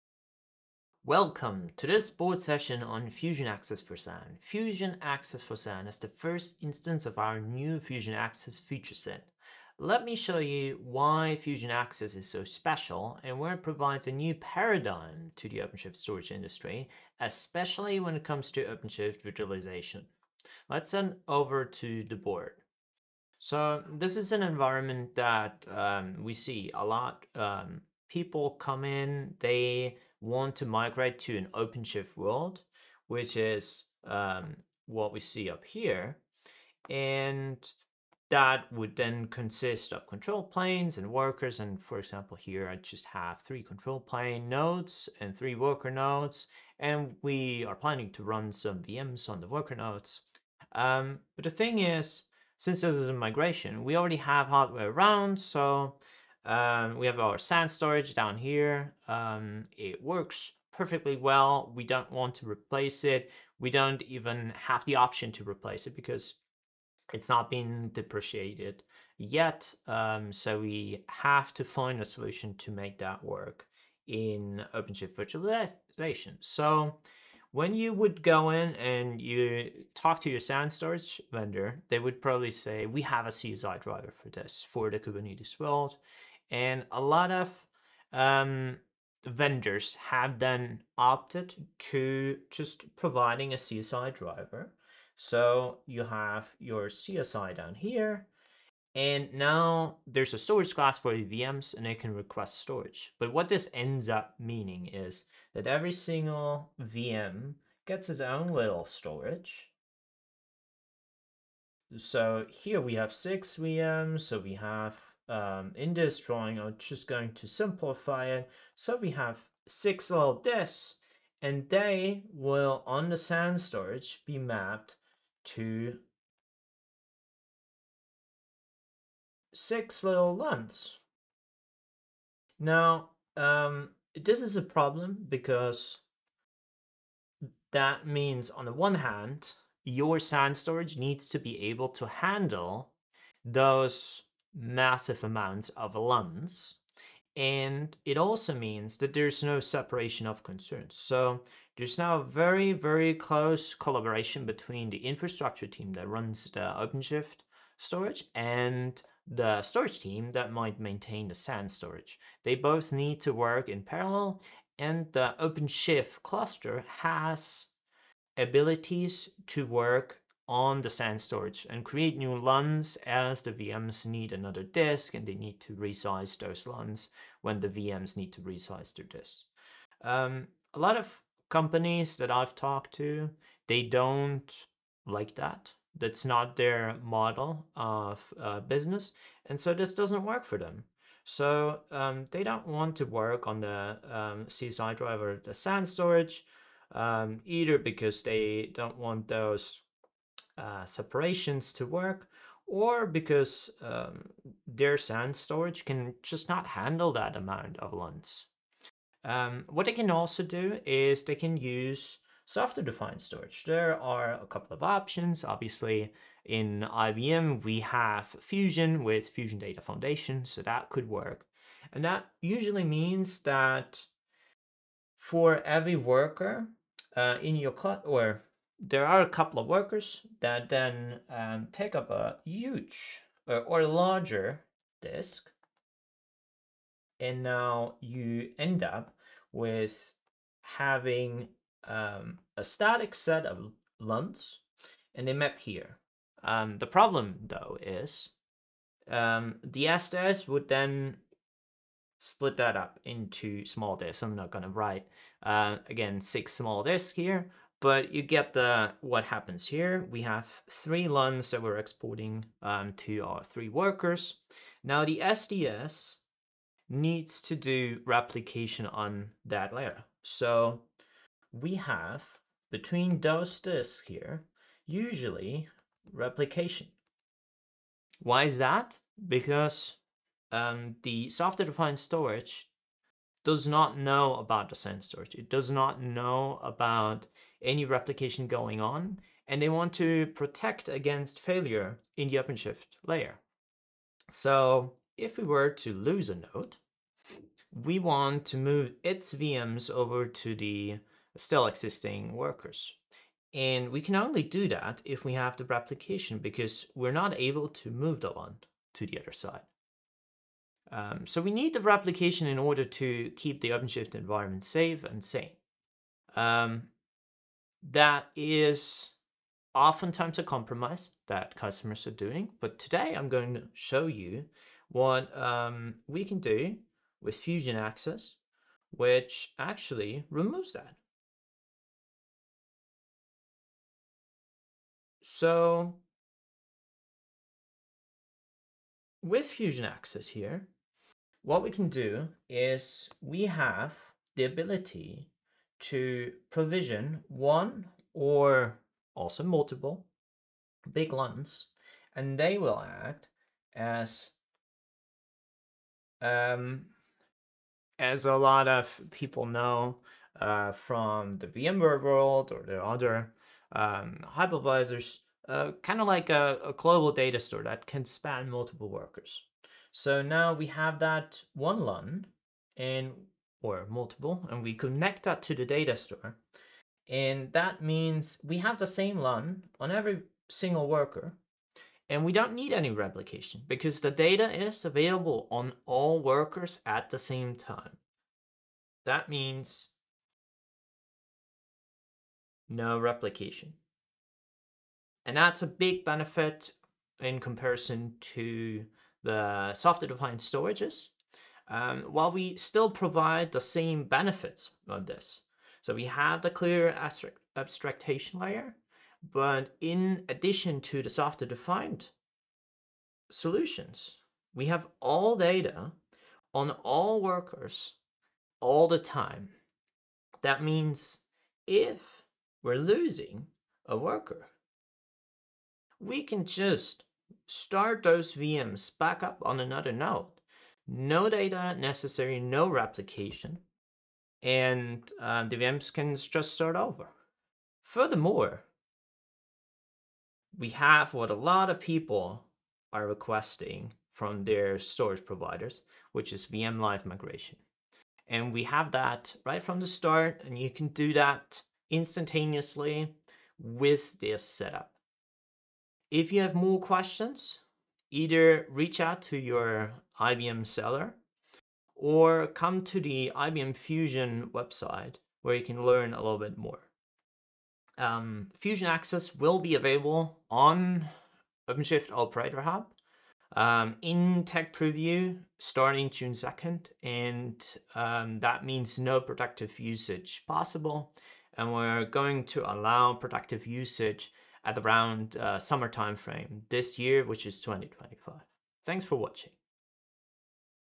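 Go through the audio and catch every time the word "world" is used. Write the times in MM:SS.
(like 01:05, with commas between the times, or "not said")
00:32, 01:25, 06:02.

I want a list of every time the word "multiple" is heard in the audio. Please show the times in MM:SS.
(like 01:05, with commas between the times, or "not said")
05:49, 06:08, 06:13.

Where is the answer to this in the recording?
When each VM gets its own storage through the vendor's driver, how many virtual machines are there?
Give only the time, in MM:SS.
01:53.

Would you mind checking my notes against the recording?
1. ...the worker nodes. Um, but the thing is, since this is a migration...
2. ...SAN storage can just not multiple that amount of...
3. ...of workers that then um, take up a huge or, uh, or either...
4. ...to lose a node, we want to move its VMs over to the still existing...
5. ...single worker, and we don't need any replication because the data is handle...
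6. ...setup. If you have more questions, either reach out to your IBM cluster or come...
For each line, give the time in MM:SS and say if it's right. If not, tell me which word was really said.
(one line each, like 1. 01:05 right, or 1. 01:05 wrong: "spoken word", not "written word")
1. 00:49 right
2. 03:24 wrong: "handle", not "multiple"
3. 03:49 wrong: "larger", not "either"
4. 04:55 right
5. 06:20 wrong: "available", not "handle"
6. 07:34 wrong: "seller", not "cluster".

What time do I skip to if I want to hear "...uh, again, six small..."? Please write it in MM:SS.
04:15.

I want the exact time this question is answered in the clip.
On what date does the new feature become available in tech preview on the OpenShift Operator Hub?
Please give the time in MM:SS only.
07:56.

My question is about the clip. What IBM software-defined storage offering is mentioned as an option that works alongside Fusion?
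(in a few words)
Fusion Data Foundation.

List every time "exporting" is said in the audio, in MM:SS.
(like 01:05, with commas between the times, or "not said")
04:21.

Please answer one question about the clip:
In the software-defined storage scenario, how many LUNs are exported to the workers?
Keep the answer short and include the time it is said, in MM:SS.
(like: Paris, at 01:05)
3, at 04:20.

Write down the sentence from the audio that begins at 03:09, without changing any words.
And so this doesn't work for them.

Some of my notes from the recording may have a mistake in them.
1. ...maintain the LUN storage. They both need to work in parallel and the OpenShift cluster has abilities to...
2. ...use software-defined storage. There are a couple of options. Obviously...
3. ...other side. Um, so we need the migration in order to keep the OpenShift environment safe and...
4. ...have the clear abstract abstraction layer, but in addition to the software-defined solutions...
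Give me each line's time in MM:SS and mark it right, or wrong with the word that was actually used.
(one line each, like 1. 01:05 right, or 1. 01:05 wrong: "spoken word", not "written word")
1. 02:40 wrong: "SAN", not "LUN"
2. 03:31 right
3. 05:09 wrong: "replication", not "migration"
4. 06:46 right.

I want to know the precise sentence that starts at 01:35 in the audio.
So you have your CSI down here, and now there's a storage class for VMs and it can request storage.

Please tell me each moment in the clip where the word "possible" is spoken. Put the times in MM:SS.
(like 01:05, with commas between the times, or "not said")
08:00.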